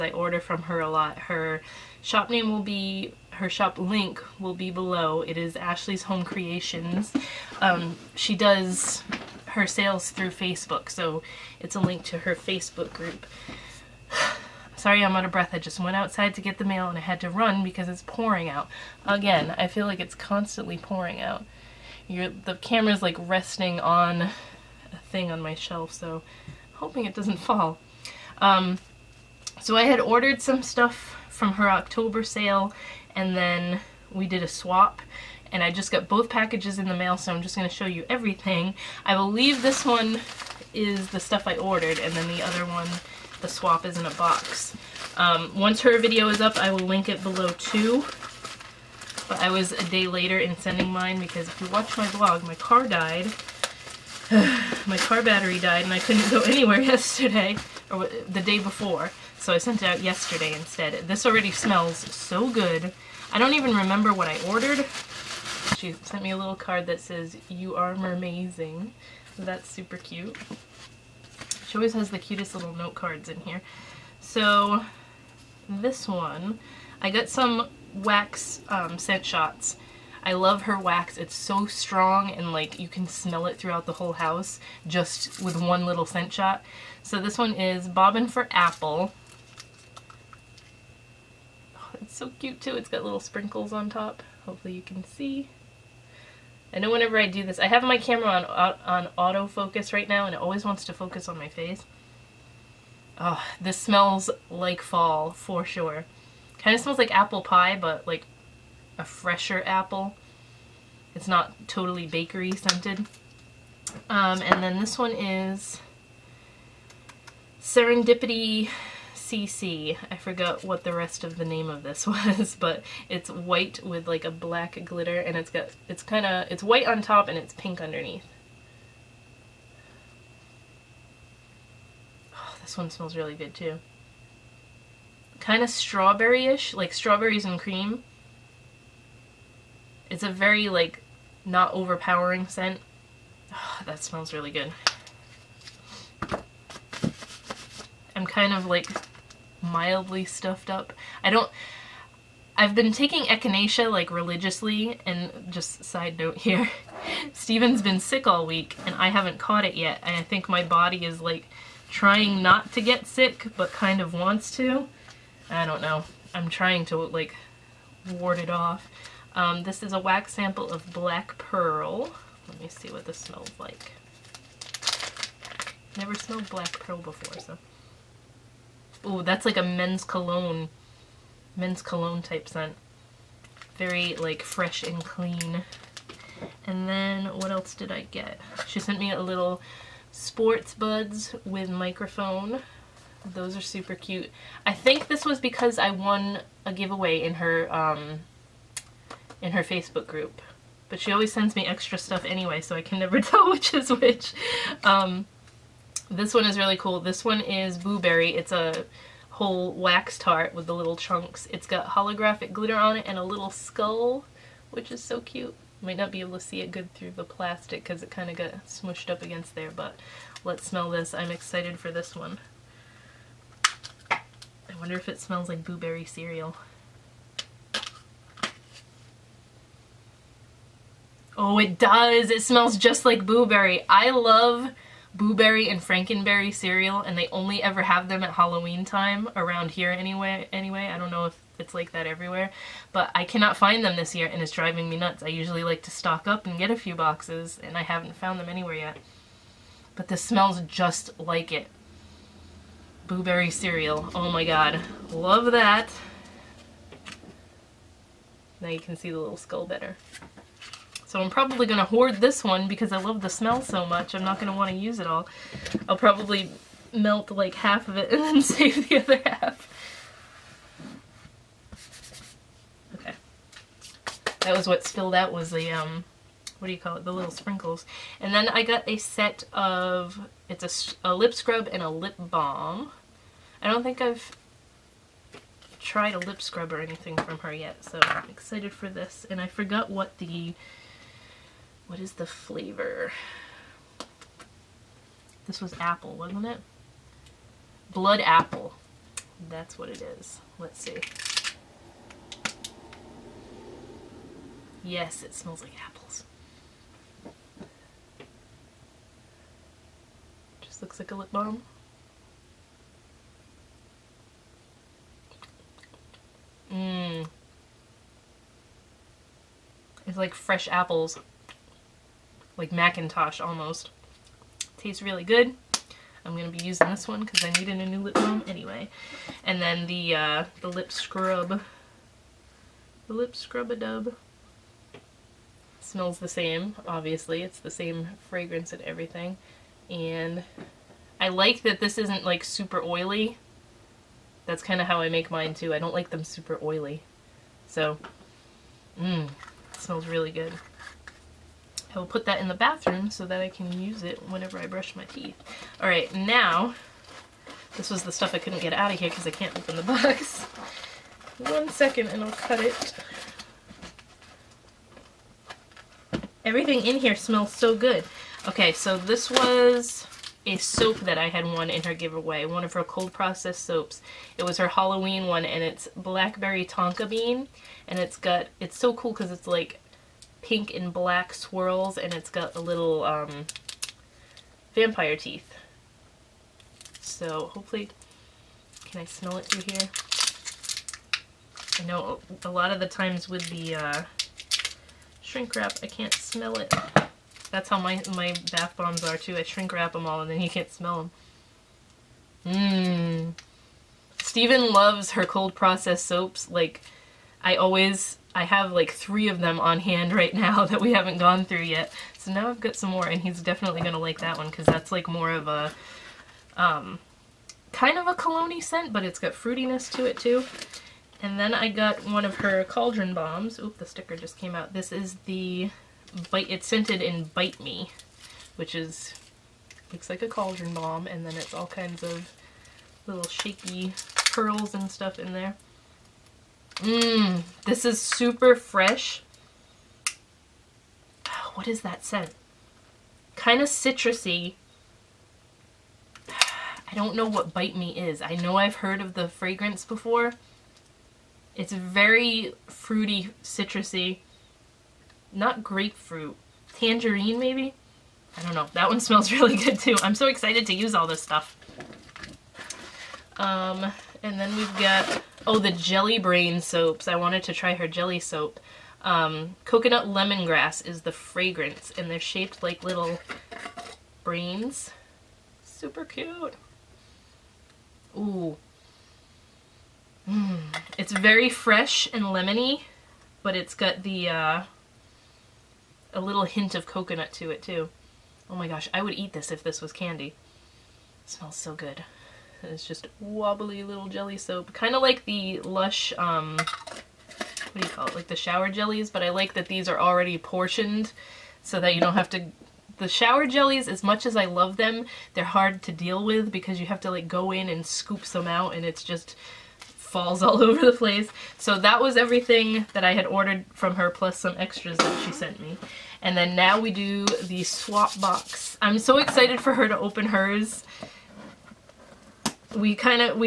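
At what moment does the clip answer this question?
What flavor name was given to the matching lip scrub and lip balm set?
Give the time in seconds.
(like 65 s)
297 s.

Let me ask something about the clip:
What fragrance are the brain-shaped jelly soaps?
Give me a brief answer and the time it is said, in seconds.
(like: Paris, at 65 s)
coconut lemongrass, at 469 s.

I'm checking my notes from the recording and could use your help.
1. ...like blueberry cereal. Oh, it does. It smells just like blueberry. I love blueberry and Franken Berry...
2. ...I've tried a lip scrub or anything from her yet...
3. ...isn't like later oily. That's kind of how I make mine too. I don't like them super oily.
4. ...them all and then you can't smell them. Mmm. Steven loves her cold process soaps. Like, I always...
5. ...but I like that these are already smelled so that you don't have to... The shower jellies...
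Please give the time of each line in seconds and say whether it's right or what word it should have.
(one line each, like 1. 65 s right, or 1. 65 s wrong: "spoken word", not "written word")
1. 225 s right
2. 284 s right
3. 341 s wrong: "super", not "later"
4. 399 s right
5. 499 s wrong: "portioned", not "smelled".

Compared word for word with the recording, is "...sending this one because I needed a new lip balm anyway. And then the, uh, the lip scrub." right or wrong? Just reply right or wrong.
wrong.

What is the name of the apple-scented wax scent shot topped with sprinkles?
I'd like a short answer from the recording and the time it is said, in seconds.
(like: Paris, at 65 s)
Bobbin for Apple, at 87 s.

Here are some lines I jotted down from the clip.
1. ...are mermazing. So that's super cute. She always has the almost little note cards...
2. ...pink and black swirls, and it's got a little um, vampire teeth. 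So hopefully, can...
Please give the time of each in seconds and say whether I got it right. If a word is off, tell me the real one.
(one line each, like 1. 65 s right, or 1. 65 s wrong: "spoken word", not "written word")
1. 67 s wrong: "cutest", not "almost"
2. 380 s right.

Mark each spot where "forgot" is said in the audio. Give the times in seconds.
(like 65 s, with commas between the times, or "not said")
120 s, 289 s.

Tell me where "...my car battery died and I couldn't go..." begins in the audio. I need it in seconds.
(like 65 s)
54 s.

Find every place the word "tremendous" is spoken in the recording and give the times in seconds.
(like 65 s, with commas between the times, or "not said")
not said.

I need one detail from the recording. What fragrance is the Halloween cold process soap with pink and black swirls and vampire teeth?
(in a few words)
blackberry tonka bean.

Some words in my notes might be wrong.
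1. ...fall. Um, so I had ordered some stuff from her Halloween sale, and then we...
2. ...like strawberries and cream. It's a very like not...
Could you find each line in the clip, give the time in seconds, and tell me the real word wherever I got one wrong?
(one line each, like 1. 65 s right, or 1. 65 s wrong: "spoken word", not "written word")
1. 27 s wrong: "October", not "Halloween"
2. 136 s right.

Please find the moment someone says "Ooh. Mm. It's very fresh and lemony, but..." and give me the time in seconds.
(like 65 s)
478 s.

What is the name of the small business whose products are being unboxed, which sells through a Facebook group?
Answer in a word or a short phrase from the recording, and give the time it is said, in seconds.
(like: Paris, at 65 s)
Ashley's Home Creations, at 5 s.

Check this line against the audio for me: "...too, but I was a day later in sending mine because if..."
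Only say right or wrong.
right.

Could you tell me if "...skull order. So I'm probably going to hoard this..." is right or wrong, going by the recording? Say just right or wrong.
wrong.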